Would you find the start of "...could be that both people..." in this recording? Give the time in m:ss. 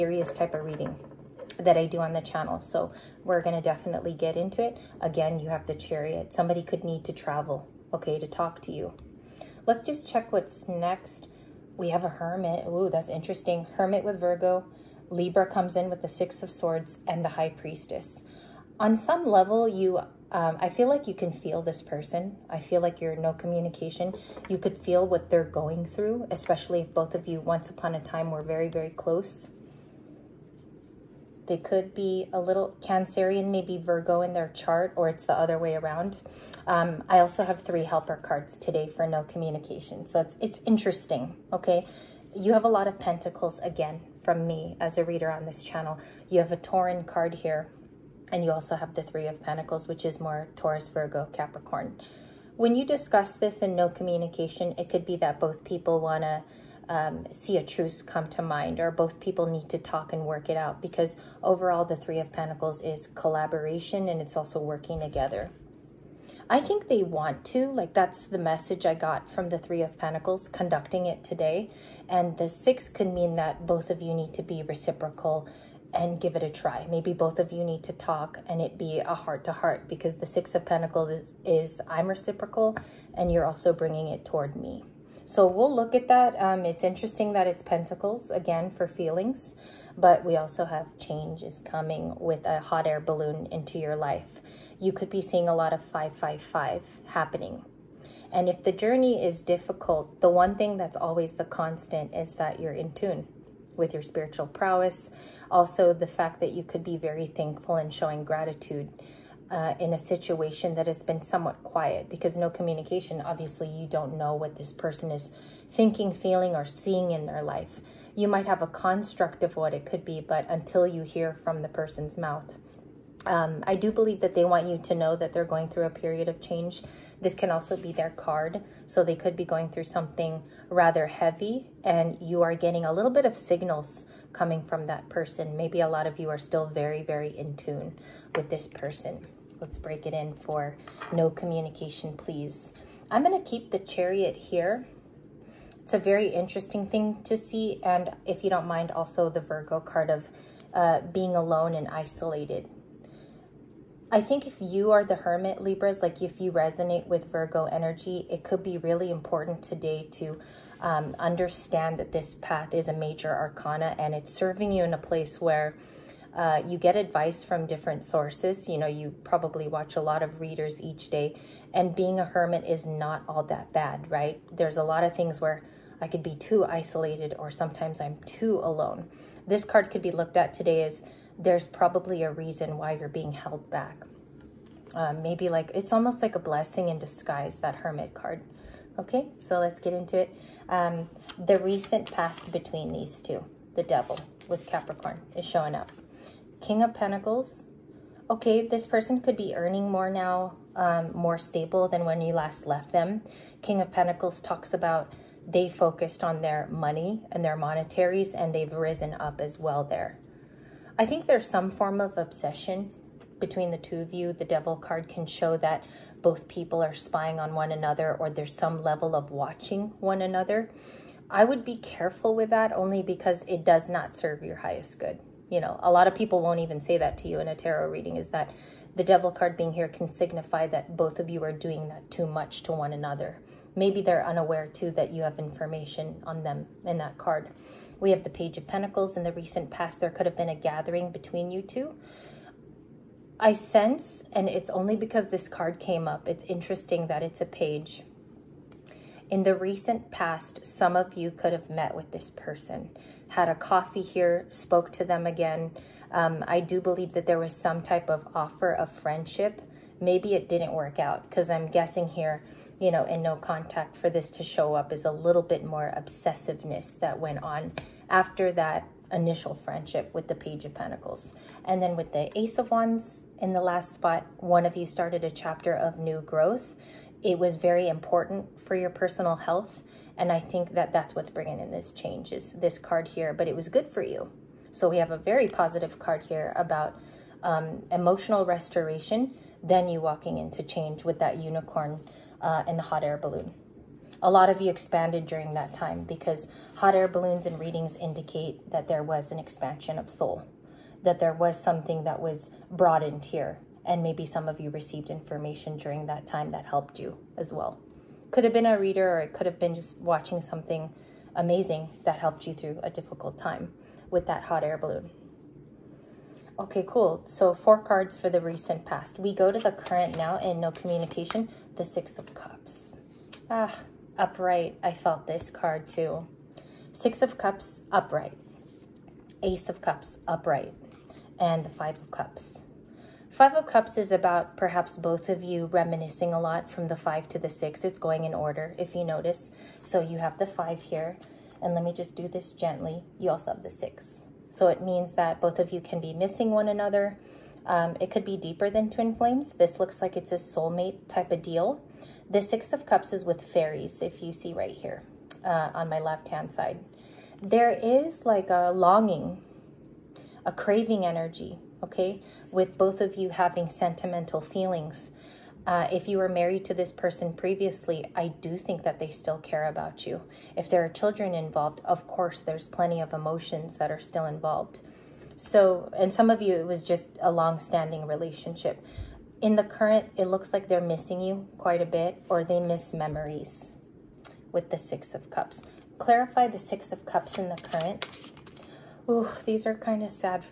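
0:54.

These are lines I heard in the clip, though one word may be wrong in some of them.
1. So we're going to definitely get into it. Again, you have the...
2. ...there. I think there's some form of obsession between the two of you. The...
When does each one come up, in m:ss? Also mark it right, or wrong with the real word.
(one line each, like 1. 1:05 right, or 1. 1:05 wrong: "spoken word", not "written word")
1. 0:02 right
2. 3:29 right.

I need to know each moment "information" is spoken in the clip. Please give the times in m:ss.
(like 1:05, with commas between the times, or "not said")
3:55, 5:05.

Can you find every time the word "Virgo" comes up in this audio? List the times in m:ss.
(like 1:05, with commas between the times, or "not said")
0:14, 0:33, 0:50, 2:29, 2:37.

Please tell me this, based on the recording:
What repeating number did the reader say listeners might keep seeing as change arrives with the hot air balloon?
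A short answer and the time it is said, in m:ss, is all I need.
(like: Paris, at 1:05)
555, at 1:35.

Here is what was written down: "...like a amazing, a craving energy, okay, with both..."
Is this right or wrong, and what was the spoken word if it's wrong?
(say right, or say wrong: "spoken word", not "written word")
wrong: "longing", not "amazing".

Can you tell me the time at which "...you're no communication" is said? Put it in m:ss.
0:23.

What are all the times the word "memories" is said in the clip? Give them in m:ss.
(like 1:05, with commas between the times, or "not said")
6:22.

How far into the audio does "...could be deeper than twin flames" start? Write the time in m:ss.
5:48.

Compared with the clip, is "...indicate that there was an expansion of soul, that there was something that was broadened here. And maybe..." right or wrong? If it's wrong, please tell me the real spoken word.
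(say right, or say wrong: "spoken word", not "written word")
right.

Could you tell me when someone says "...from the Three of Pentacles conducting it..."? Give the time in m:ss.
1:09.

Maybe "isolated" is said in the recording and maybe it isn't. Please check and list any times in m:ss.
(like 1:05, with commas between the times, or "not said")
2:31, 2:56.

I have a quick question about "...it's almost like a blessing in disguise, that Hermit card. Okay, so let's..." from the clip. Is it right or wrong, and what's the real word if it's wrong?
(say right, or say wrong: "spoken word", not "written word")
right.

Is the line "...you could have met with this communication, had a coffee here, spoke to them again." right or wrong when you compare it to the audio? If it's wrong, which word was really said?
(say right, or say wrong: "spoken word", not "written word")
wrong: "person", not "communication".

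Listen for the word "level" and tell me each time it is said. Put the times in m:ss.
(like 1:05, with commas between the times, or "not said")
0:19, 3:38.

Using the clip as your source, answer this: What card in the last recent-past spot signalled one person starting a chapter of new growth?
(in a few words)
Ace of Wands.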